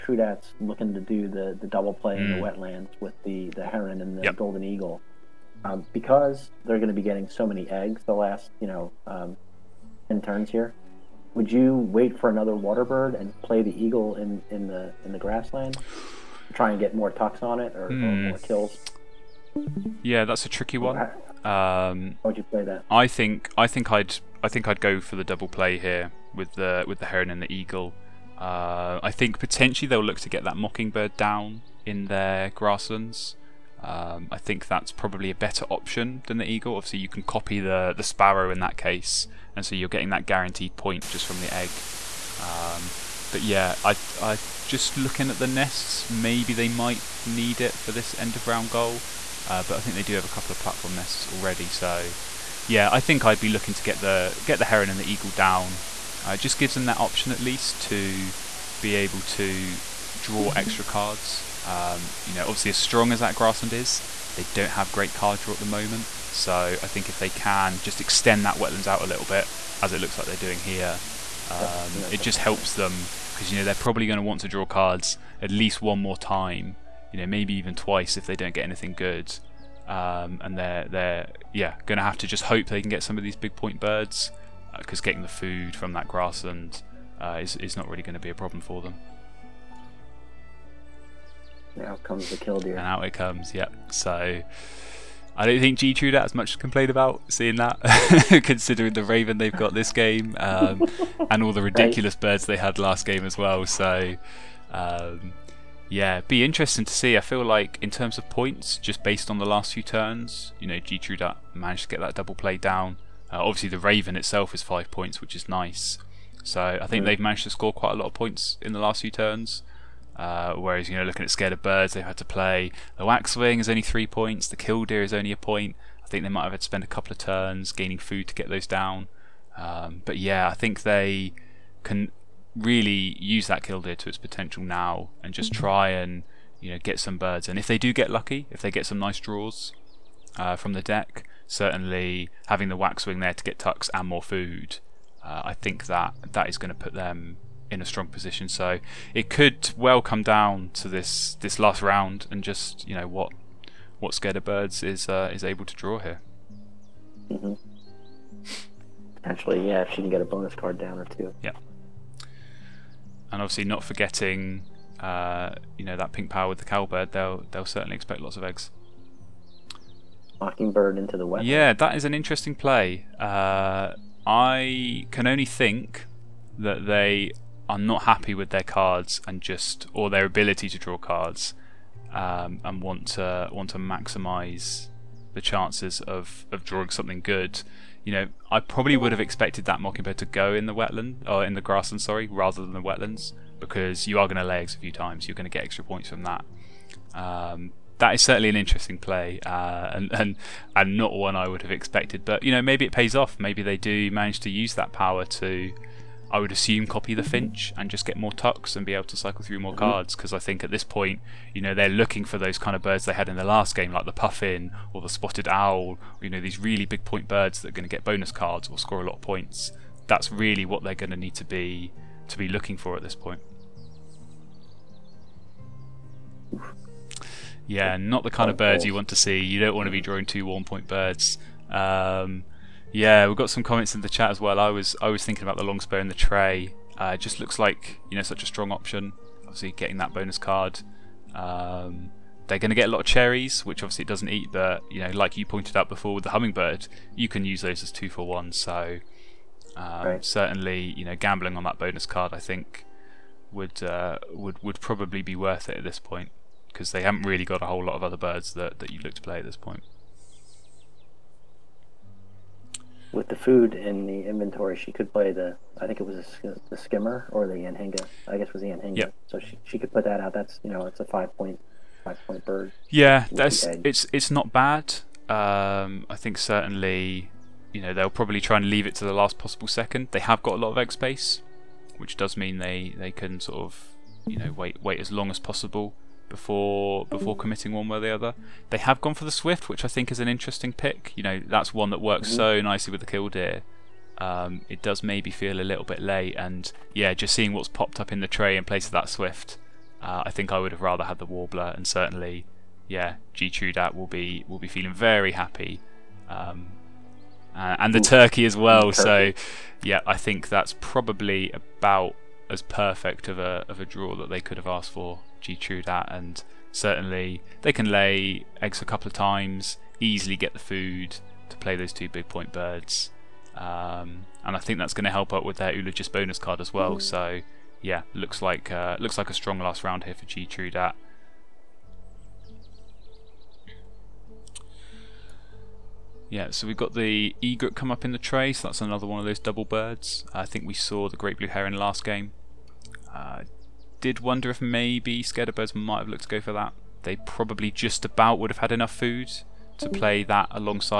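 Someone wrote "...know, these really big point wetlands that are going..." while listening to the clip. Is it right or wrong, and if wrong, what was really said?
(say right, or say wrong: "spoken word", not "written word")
wrong: "birds", not "wetlands".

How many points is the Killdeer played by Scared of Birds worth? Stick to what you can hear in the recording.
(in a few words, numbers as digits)
1.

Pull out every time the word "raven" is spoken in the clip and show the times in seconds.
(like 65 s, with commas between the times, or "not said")
99 s, 113 s.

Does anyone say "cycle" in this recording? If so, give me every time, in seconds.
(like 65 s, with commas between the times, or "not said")
209 s.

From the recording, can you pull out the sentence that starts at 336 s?
Yeah, so we've got the egret come up in the tray, so that's another one of those double birds.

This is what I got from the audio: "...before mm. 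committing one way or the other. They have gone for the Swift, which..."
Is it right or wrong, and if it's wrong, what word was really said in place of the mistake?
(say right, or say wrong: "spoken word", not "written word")
right.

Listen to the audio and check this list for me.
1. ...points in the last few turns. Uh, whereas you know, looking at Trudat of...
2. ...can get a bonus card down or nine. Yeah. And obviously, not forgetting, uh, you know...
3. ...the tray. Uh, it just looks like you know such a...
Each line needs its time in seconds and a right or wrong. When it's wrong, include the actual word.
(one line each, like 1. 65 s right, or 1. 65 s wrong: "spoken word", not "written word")
1. 118 s wrong: "Scared", not "Trudat"
2. 159 s wrong: "two", not "nine"
3. 236 s right.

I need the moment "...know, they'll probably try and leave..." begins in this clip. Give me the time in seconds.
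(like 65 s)
277 s.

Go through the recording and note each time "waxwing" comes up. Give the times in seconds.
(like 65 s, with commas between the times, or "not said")
123 s, 142 s.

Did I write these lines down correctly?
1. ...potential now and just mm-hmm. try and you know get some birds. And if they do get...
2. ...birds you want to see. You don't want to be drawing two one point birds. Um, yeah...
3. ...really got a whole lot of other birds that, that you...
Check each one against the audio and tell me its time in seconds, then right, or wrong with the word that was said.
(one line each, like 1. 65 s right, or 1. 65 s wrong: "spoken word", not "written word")
1. 134 s right
2. 228 s right
3. 257 s right.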